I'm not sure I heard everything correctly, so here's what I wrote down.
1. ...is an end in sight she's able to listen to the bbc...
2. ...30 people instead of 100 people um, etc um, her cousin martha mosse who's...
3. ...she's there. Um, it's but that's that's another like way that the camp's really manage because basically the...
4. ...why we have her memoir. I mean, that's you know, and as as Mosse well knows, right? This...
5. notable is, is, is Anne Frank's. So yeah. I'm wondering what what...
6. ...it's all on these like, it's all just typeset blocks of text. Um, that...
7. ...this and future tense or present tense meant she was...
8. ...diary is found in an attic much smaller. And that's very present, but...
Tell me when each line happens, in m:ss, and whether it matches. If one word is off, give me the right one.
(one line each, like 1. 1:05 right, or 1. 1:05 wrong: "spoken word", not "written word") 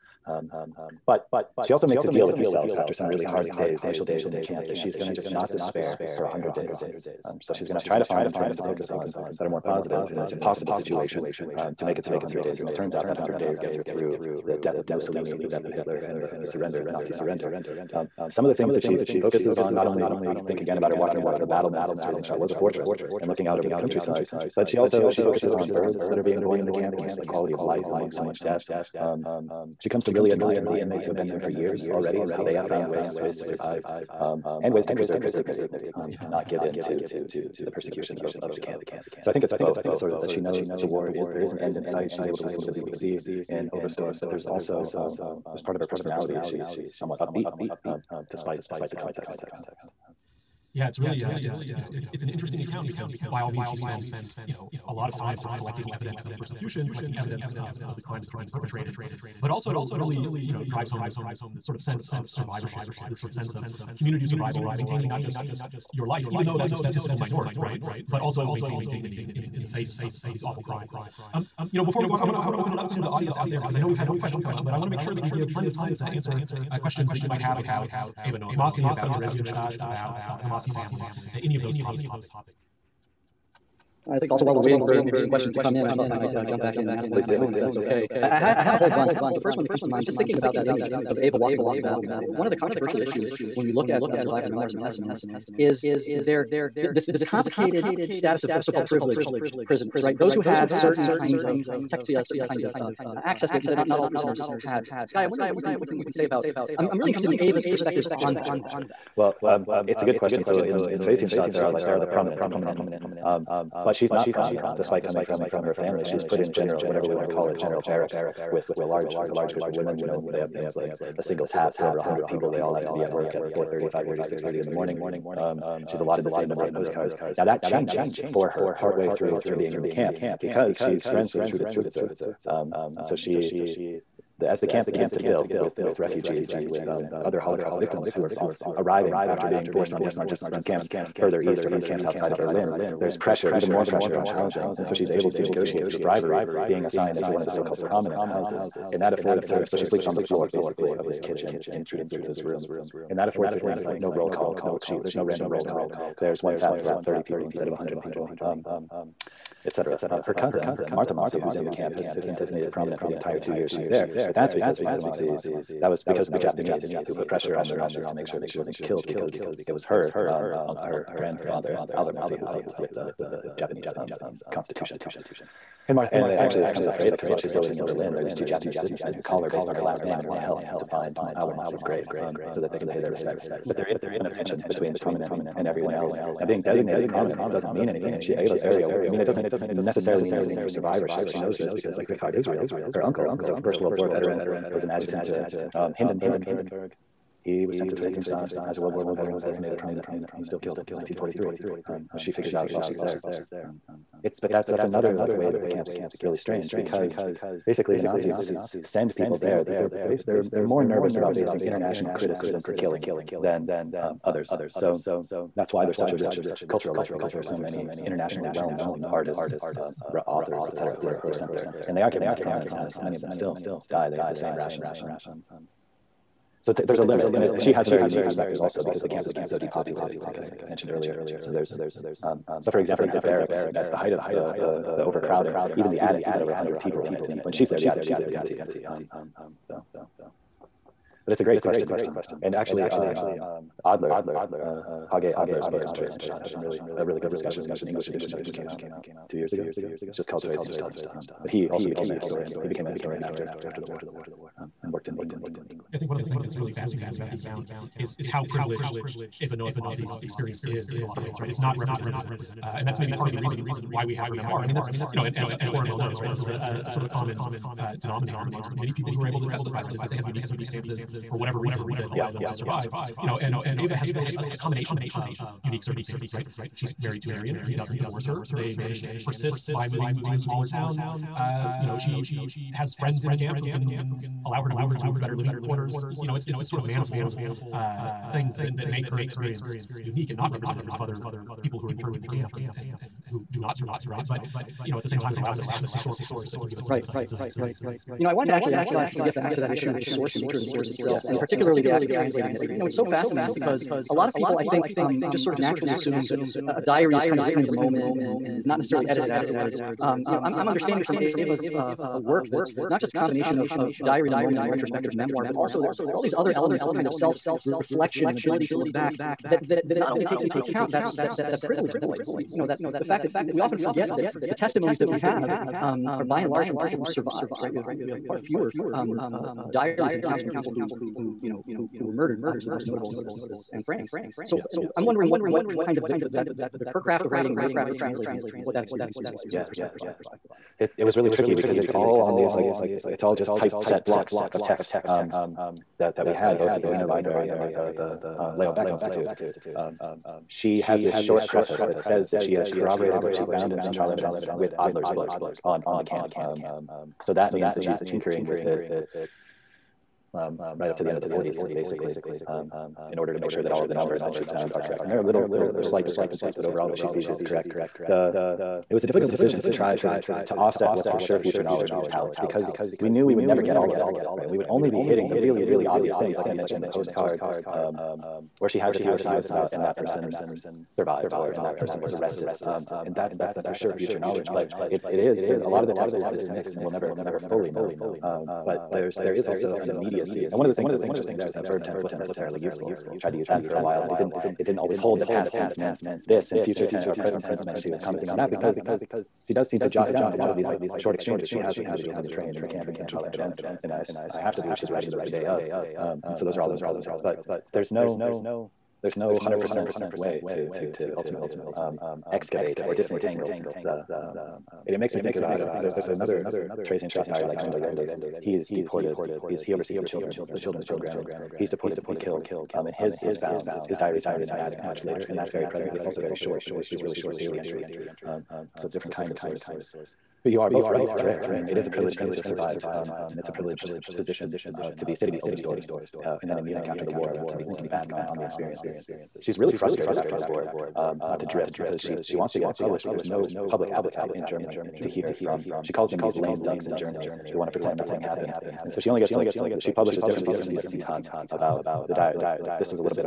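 1. 0:41 right
2. 2:37 right
3. 3:22 wrong: "strange", not "manage"
4. 4:23 wrong: "Oren", not "Mosse"
5. 5:32 right
6. 5:41 right
7. 6:36 right
8. 7:03 wrong: "later", not "smaller".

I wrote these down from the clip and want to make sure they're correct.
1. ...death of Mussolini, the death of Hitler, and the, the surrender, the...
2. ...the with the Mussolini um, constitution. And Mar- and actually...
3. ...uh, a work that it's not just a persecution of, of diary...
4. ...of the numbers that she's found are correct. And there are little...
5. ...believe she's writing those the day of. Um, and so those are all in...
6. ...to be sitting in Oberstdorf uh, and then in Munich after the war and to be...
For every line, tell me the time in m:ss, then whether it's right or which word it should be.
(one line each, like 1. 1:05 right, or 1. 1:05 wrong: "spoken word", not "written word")
1. 0:14 right
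2. 2:52 wrong: "Japanese", not "Mussolini"
3. 5:11 wrong: "combination", not "persecution"
4. 6:03 right
5. 6:44 right
6. 7:14 right.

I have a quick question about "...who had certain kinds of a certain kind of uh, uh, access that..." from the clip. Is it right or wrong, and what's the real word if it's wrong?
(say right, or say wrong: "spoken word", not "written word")
right.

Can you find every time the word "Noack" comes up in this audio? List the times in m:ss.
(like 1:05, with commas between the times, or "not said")
1:18, 4:19.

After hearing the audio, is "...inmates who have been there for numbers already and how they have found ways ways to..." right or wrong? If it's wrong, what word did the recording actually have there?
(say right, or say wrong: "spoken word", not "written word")
wrong: "years", not "numbers".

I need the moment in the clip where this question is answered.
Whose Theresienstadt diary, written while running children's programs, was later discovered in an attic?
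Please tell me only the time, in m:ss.
6:57.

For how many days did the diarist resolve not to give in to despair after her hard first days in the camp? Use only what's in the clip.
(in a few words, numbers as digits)
100.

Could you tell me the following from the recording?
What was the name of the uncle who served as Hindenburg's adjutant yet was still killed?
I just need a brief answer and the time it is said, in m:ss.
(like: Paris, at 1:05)
Richard Israel, at 3:12.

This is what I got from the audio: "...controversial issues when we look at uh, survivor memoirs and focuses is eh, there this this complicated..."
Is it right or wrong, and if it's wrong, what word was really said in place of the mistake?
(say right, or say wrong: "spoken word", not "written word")
wrong: "testimonies", not "focuses".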